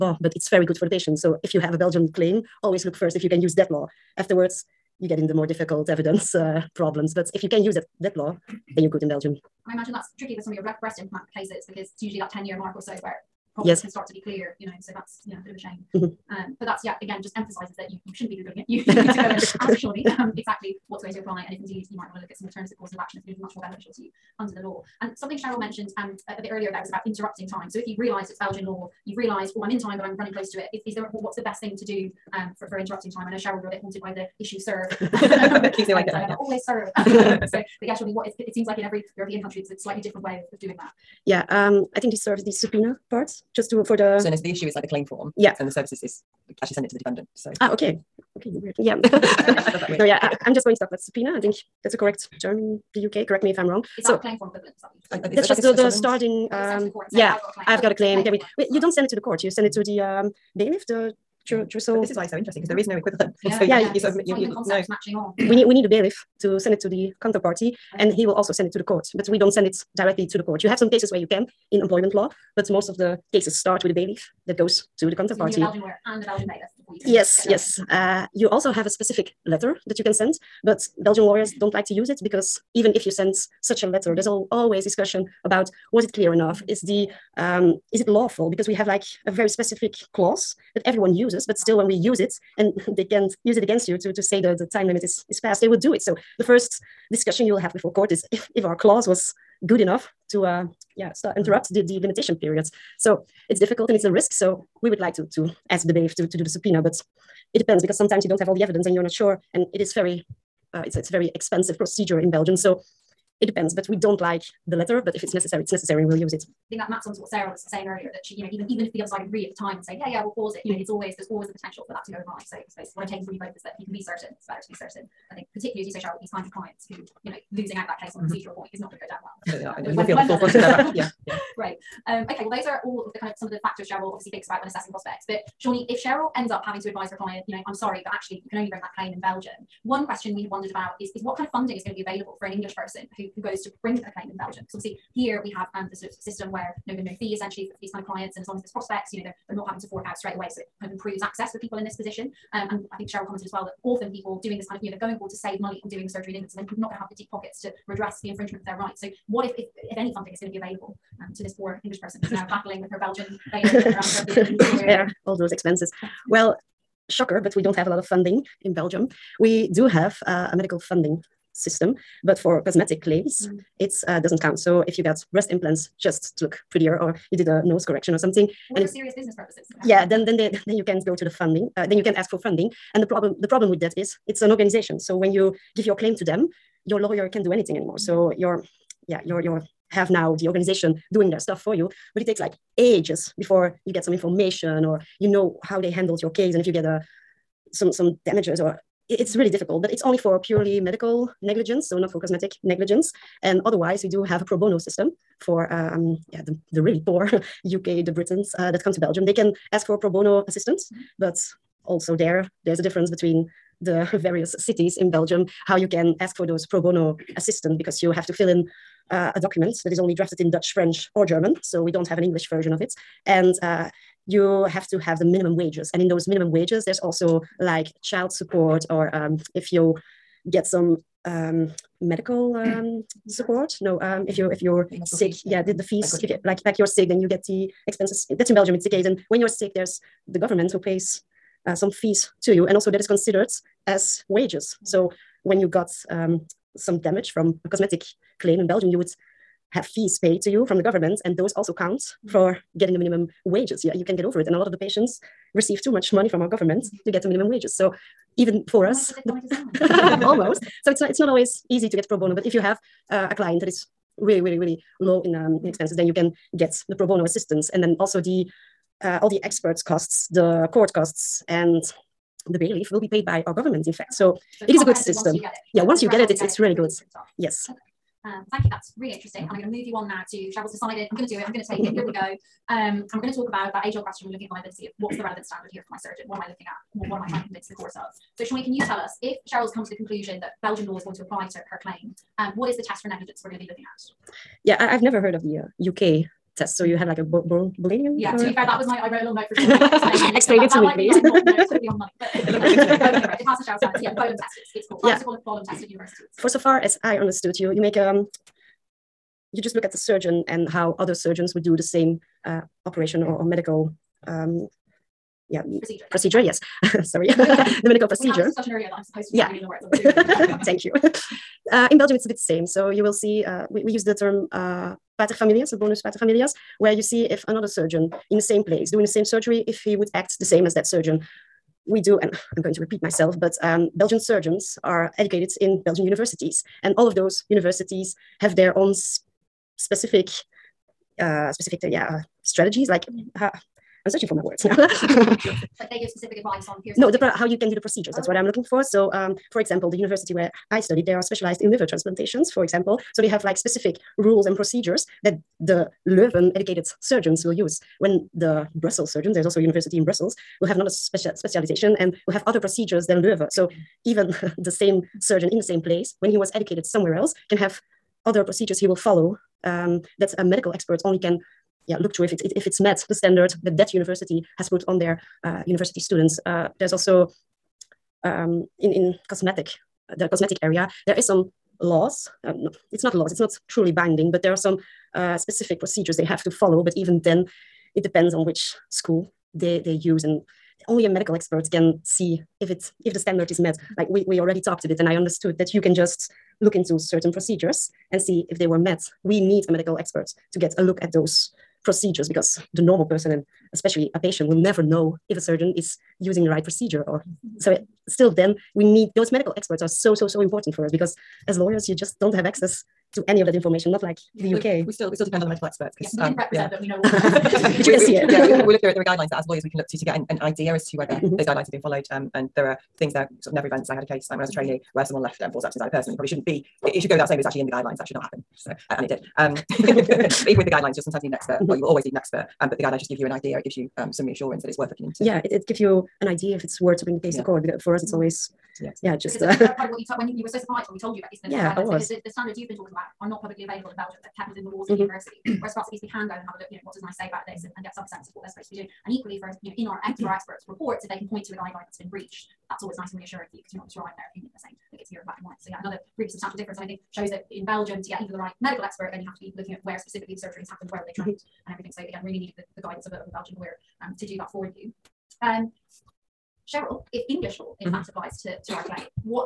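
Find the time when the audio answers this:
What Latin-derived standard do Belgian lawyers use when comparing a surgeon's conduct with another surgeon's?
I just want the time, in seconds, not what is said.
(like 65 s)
325 s.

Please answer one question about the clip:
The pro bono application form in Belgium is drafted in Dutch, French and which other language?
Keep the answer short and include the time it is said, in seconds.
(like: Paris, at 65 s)
German, at 221 s.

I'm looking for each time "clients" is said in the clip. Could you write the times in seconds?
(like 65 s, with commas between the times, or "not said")
126 s, 137 s, 148 s, 263 s.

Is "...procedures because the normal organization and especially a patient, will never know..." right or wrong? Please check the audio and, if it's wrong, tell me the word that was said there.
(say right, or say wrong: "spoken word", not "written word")
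wrong: "person", not "organization".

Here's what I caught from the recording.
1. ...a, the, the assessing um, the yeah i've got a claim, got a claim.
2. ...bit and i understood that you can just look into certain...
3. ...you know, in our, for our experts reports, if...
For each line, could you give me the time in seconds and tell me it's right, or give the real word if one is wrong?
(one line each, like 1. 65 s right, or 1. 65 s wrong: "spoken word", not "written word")
1. 55 s wrong: "starting", not "assessing"
2. 394 s right
3. 449 s right.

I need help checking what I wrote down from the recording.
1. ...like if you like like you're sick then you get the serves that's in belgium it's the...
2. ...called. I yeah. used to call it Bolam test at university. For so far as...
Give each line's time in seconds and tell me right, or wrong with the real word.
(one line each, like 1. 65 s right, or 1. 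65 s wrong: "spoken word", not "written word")
1. 236 s wrong: "expenses", not "serves"
2. 304 s right.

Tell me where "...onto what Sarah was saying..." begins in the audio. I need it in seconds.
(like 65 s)
117 s.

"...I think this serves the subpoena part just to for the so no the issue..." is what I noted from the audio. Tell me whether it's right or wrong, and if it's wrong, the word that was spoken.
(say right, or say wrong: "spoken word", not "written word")
right.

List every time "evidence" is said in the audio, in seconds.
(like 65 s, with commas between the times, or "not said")
5 s, 108 s.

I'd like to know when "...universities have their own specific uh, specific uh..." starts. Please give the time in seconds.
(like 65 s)
337 s.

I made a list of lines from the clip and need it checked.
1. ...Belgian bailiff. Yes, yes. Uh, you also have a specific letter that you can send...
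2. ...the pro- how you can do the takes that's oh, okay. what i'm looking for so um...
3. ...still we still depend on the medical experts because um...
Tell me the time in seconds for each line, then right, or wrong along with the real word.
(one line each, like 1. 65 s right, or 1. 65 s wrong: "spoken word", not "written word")
1. 76 s right
2. 347 s wrong: "procedures", not "takes"
3. 414 s right.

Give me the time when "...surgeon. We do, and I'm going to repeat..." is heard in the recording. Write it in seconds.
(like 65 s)
330 s.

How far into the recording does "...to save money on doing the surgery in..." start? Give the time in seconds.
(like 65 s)
155 s.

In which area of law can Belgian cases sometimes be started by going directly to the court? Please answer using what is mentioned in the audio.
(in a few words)
Employment law.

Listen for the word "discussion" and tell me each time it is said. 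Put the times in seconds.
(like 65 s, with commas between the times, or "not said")
84 s, 97 s, 318 s.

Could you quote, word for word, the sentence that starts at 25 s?
And something Cheryl mentioned um, a, a, bit earlier there was about interrupting time.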